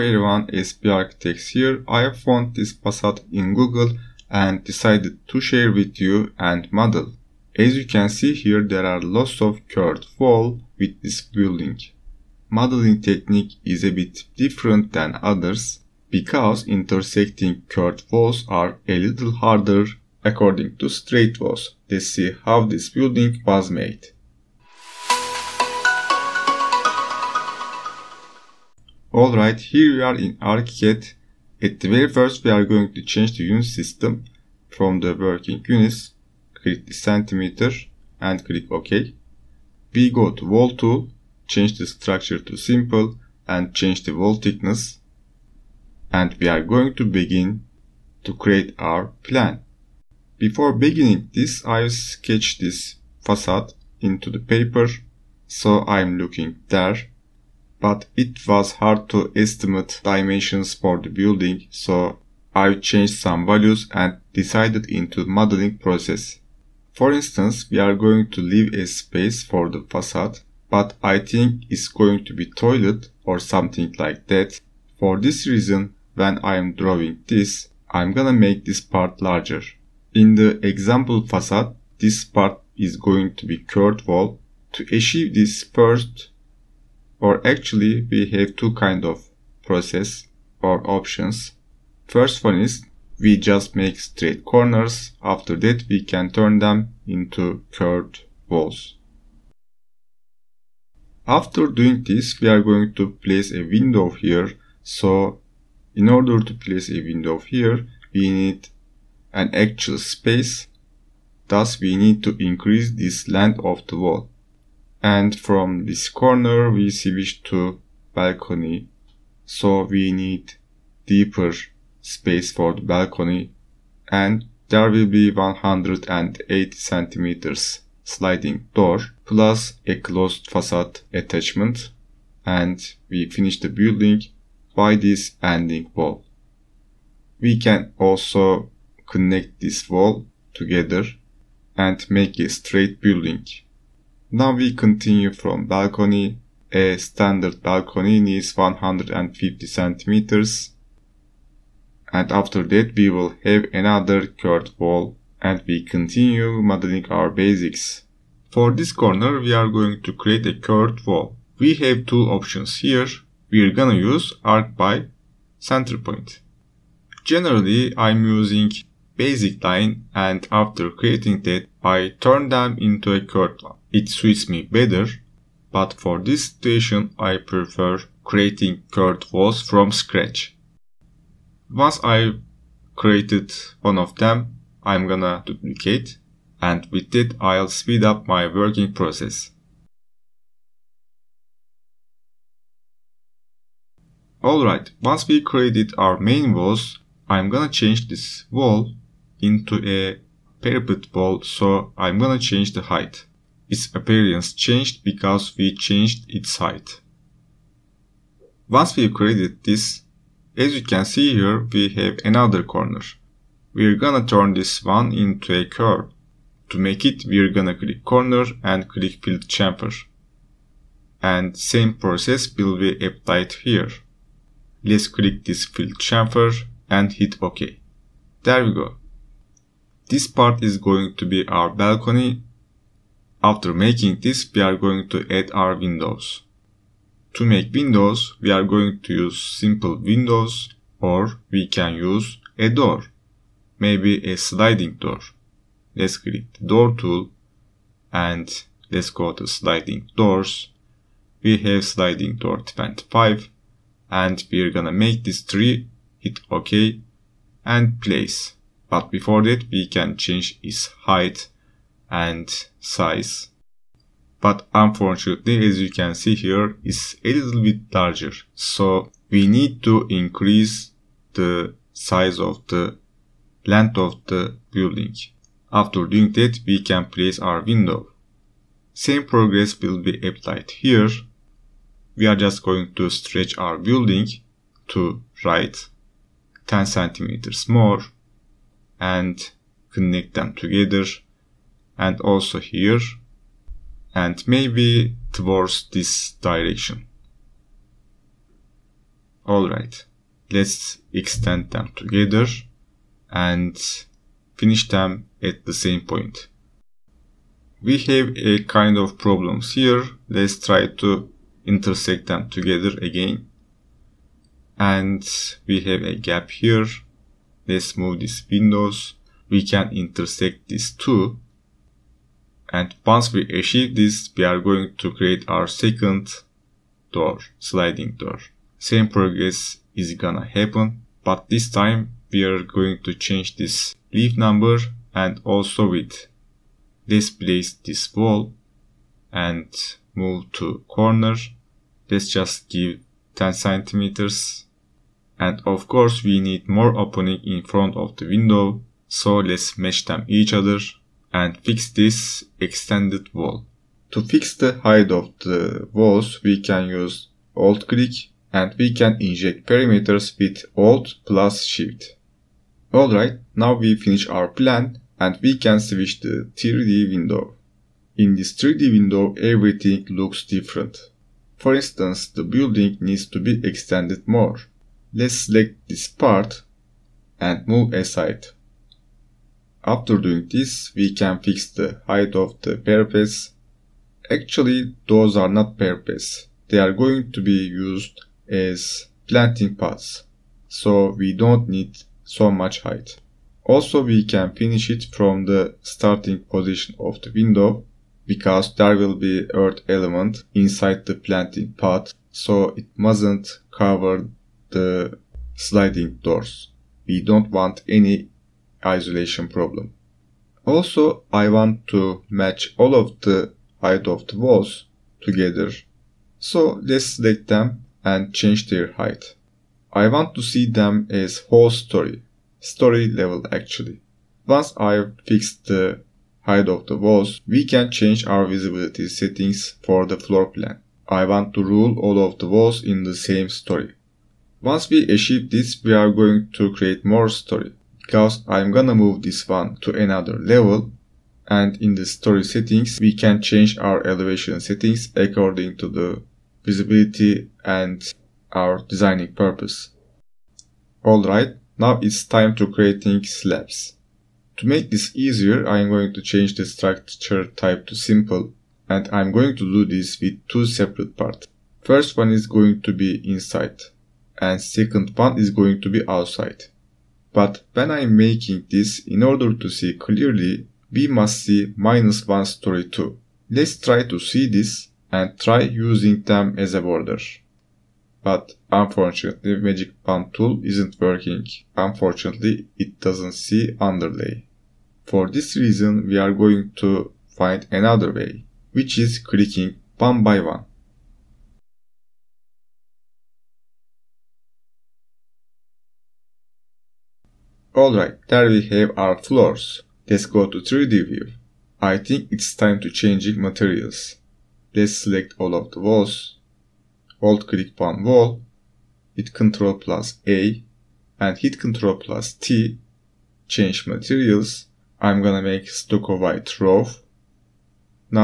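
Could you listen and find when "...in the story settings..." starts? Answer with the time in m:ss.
7:21.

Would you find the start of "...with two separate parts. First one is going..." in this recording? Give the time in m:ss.
7:40.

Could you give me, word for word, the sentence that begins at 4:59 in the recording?
Alright, let's extend them together and finish them at the same point.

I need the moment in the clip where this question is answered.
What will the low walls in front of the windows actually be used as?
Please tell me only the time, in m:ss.
6:29.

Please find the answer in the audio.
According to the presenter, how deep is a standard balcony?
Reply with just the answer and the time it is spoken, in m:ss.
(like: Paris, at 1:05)
150 centimeters, at 2:28.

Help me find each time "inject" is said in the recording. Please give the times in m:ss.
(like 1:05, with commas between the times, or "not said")
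5:59.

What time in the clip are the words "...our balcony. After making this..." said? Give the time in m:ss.
3:51.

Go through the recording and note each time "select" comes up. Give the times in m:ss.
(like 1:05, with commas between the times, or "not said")
6:15, 6:57, 8:24.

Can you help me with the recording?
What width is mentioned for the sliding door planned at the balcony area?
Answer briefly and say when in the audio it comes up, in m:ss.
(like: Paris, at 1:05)
180 centimeters, at 2:05.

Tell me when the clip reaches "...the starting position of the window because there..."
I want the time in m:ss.
6:35.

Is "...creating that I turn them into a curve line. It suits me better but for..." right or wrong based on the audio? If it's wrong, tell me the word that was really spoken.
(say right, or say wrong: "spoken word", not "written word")
right.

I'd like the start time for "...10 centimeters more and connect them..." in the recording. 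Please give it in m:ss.
4:46.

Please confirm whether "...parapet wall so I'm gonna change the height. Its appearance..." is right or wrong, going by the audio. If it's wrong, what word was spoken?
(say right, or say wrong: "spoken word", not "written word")
right.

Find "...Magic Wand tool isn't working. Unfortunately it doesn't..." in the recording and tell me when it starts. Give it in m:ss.
7:59.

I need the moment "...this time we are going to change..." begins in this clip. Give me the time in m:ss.
5:31.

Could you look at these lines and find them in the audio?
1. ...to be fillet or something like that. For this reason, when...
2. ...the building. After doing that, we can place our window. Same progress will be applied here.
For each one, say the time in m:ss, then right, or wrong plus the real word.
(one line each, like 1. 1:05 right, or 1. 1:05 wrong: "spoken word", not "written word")
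1. 1:12 wrong: "toilet", not "fillet"
2. 4:34 right.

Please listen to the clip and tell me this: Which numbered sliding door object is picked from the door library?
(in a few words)
sliding door 25.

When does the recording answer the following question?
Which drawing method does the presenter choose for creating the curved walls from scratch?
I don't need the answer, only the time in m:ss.
2:44.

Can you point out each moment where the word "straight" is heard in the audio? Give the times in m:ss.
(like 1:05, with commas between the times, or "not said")
0:20, 1:33, 2:22.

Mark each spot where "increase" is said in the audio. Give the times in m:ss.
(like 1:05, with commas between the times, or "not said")
1:52, 4:30.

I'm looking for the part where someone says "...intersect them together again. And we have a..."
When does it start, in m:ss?
5:11.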